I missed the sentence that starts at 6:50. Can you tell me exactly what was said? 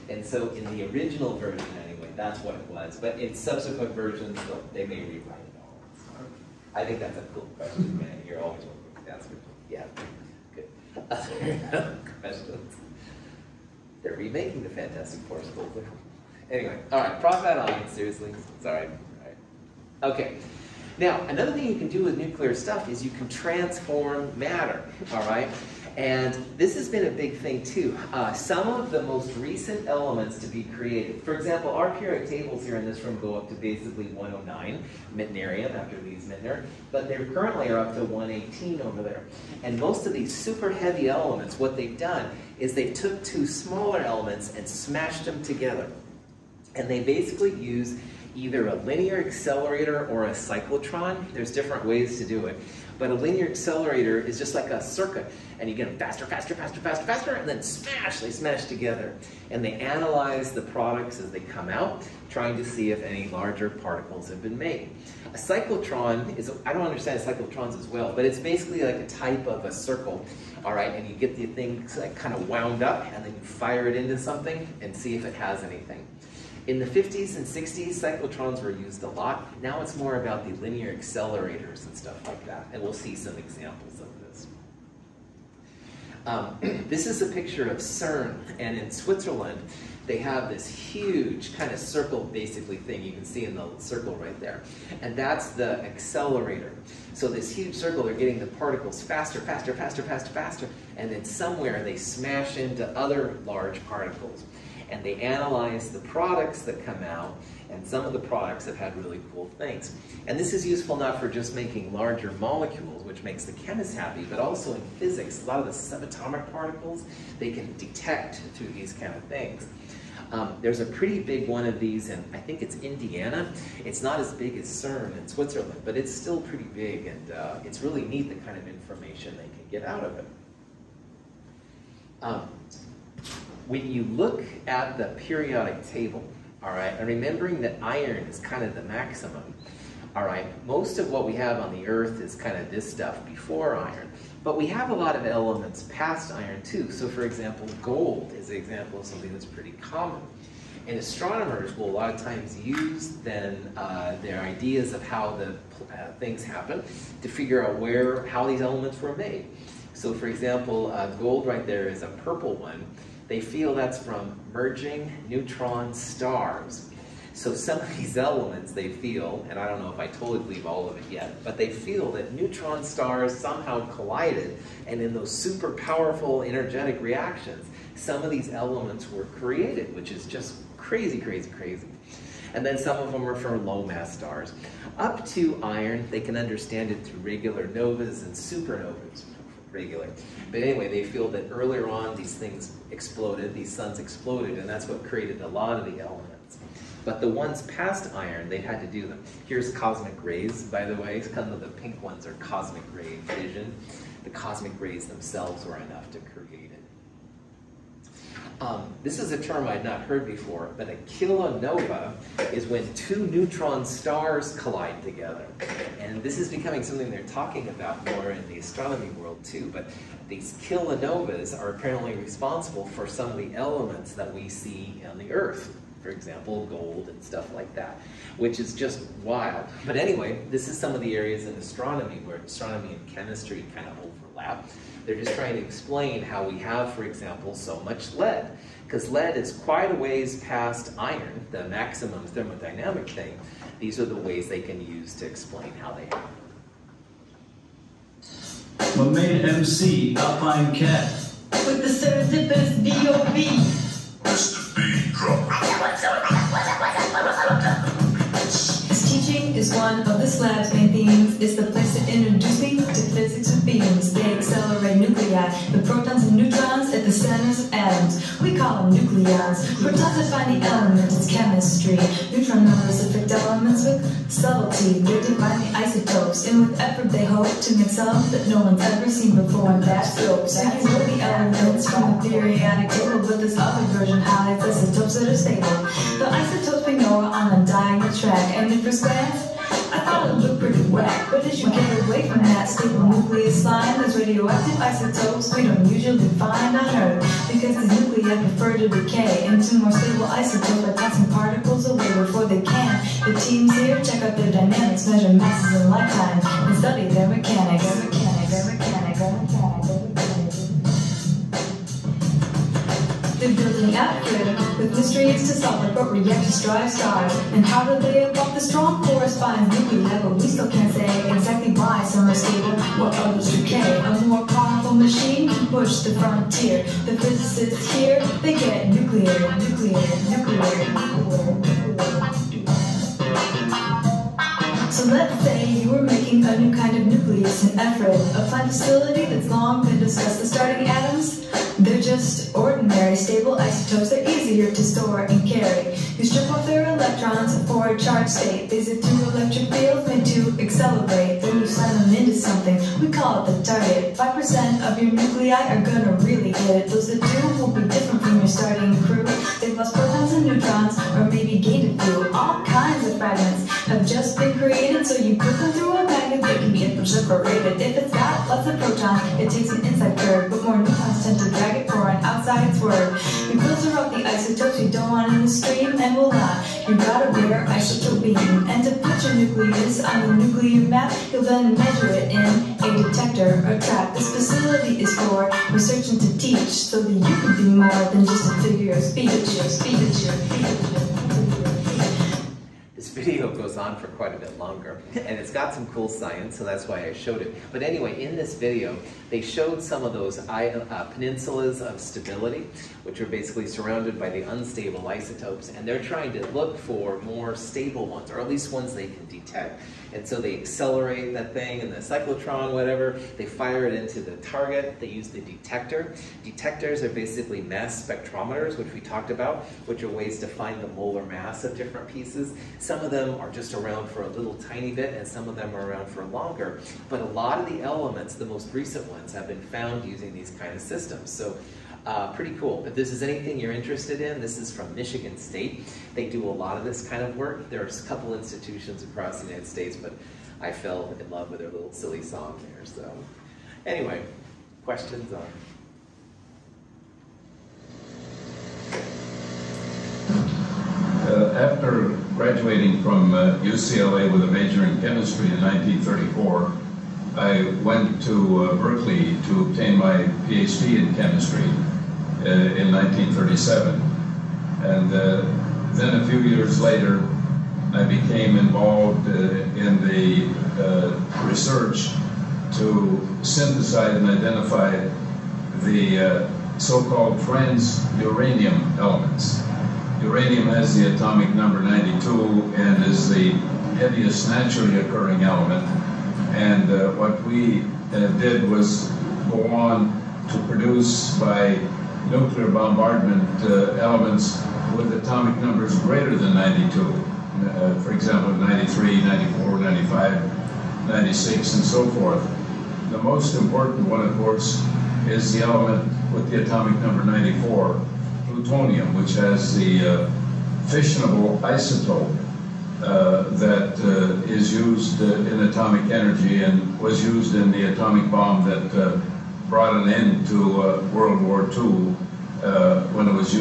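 And so they accelerate that thing in the cyclotron, whatever.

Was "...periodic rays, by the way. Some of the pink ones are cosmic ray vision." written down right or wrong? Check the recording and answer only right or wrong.
wrong.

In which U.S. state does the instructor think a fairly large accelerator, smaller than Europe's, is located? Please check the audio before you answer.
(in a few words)
Indiana.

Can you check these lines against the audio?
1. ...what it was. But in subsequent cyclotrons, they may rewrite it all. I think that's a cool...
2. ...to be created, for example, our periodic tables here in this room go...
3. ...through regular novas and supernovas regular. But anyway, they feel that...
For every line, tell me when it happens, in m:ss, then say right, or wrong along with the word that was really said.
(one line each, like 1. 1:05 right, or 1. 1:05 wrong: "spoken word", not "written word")
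1. 0:02 wrong: "versions", not "cyclotrons"
2. 0:30 right
3. 3:07 right.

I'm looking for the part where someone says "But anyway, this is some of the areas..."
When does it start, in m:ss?
3:49.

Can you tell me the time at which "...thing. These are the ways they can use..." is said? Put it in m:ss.
4:03.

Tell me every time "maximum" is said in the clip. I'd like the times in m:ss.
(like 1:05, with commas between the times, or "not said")
2:18, 4:01.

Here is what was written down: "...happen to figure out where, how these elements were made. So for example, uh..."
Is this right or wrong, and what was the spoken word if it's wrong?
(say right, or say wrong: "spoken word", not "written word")
right.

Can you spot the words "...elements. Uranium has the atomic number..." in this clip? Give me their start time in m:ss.
7:58.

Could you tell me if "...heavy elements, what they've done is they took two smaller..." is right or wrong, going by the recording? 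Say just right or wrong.
right.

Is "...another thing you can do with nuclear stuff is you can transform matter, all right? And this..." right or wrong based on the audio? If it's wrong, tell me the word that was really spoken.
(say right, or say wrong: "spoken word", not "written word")
right.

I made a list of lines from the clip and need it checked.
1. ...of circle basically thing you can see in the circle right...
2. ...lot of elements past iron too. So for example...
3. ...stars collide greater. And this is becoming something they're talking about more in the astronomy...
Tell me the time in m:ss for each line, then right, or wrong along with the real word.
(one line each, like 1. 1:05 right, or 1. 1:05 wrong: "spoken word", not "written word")
1. 1:31 right
2. 2:24 right
3. 3:33 wrong: "together", not "greater".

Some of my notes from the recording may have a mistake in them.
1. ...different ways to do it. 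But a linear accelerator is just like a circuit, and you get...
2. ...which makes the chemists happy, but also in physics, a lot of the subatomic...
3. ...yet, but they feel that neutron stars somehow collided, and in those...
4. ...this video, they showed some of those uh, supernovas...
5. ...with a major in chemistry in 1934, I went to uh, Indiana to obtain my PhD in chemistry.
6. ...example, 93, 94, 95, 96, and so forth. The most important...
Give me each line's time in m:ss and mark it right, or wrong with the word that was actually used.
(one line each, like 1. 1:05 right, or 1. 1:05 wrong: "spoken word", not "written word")
1. 0:51 right
2. 1:53 right
3. 2:51 right
4. 6:38 wrong: "peninsulas", not "supernovas"
5. 7:34 wrong: "Berkeley", not "Indiana"
6. 8:18 right.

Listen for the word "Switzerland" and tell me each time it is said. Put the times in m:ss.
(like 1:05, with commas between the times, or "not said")
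1:28, 2:05.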